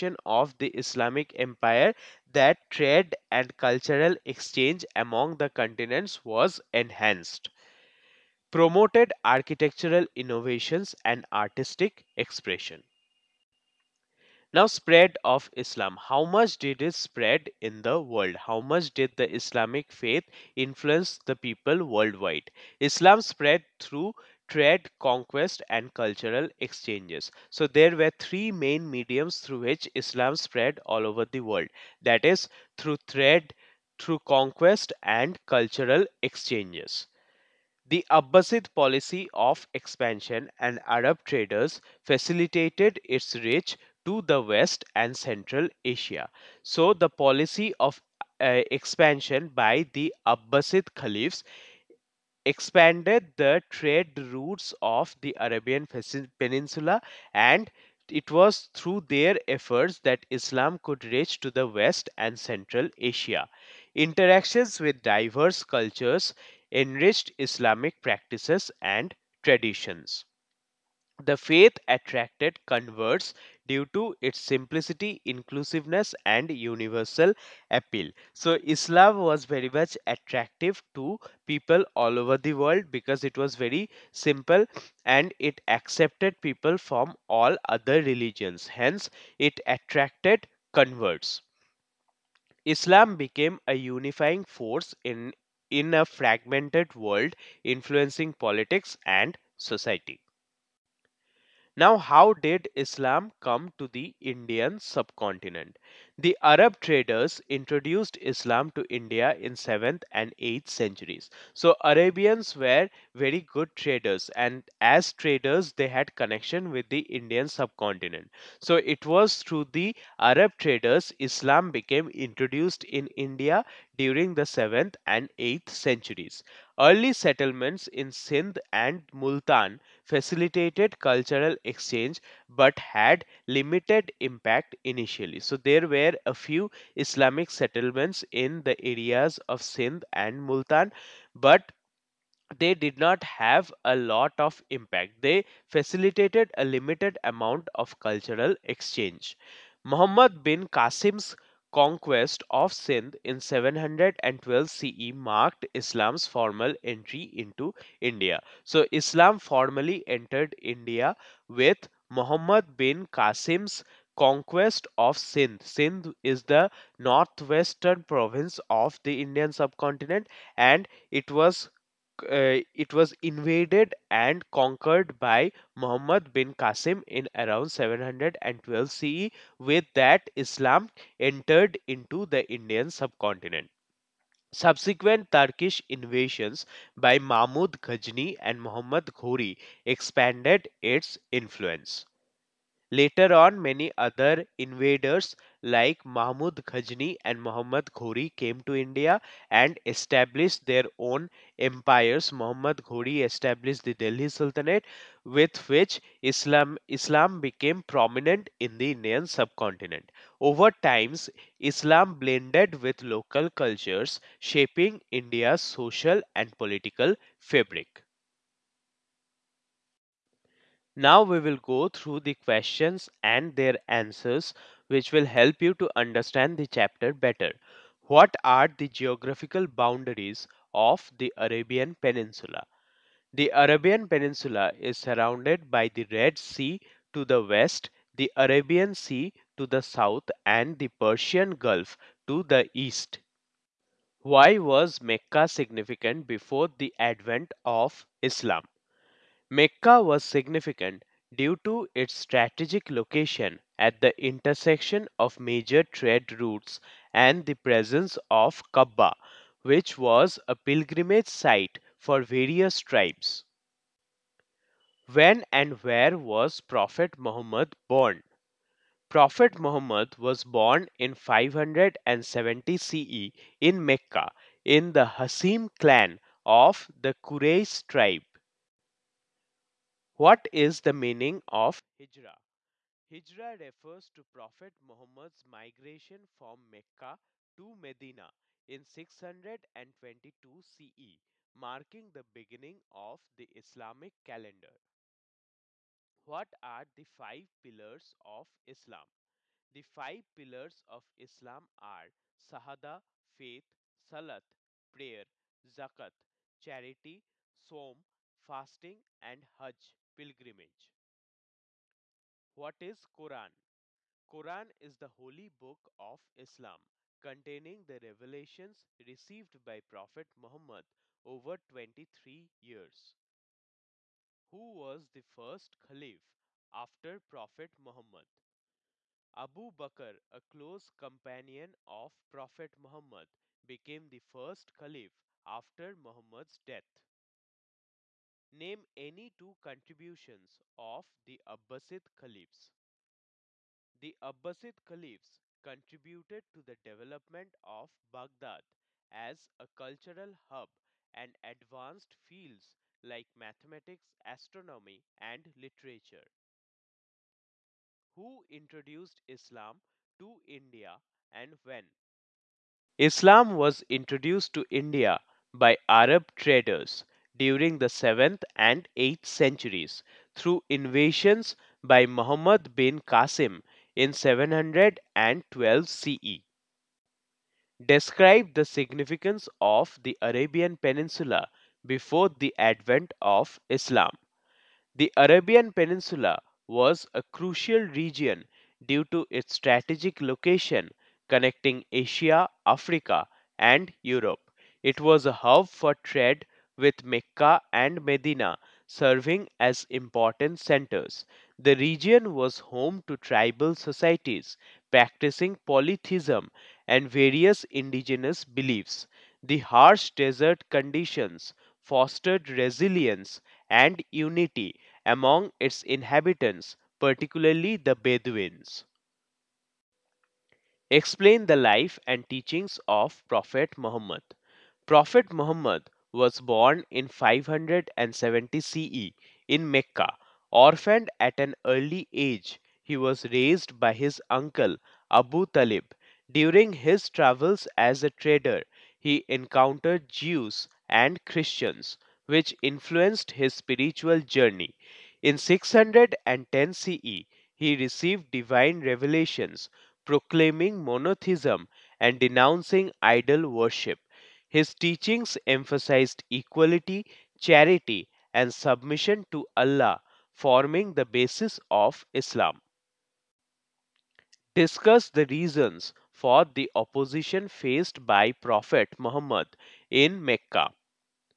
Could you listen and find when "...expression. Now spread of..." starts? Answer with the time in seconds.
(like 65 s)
12 s.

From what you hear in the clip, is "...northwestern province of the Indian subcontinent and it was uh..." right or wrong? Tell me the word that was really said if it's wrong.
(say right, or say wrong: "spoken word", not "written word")
right.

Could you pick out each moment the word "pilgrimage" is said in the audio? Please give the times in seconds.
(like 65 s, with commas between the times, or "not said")
260 s, 310 s.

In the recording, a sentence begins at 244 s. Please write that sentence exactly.
Why was Mecca significant before the advent of Islam?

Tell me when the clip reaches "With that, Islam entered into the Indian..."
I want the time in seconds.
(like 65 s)
179 s.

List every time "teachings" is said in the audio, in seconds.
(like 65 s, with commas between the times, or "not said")
422 s, 454 s.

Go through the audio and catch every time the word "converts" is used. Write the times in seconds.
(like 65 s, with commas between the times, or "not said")
72 s, 90 s.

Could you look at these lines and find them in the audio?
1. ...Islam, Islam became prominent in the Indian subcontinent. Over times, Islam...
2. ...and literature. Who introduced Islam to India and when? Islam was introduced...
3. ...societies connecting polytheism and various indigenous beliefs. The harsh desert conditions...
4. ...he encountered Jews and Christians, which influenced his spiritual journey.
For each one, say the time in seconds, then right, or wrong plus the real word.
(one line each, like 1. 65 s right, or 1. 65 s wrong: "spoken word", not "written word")
1. 206 s right
2. 355 s right
3. 403 s wrong: "practicing", not "connecting"
4. 438 s right.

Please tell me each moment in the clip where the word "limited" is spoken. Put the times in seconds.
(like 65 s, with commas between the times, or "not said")
133 s, 146 s.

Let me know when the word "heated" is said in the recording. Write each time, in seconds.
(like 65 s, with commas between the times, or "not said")
not said.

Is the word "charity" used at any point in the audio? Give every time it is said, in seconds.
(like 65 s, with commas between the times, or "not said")
306 s, 457 s.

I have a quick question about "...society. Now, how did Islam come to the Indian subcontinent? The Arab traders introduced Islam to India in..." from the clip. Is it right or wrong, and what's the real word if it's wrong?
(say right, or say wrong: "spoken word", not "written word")
right.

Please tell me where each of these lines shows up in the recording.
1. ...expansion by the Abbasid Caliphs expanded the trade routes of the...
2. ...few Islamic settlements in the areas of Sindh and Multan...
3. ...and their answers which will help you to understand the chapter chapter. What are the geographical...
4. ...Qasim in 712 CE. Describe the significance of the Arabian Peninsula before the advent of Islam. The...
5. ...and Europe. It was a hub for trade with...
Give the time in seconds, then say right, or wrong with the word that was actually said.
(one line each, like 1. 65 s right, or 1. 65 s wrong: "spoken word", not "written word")
1. 48 s right
2. 136 s right
3. 223 s wrong: "better", not "chapter"
4. 373 s right
5. 393 s right.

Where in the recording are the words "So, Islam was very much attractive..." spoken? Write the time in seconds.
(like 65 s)
78 s.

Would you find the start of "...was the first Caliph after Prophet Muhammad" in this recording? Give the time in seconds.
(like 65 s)
324 s.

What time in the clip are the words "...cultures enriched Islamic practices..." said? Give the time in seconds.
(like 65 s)
65 s.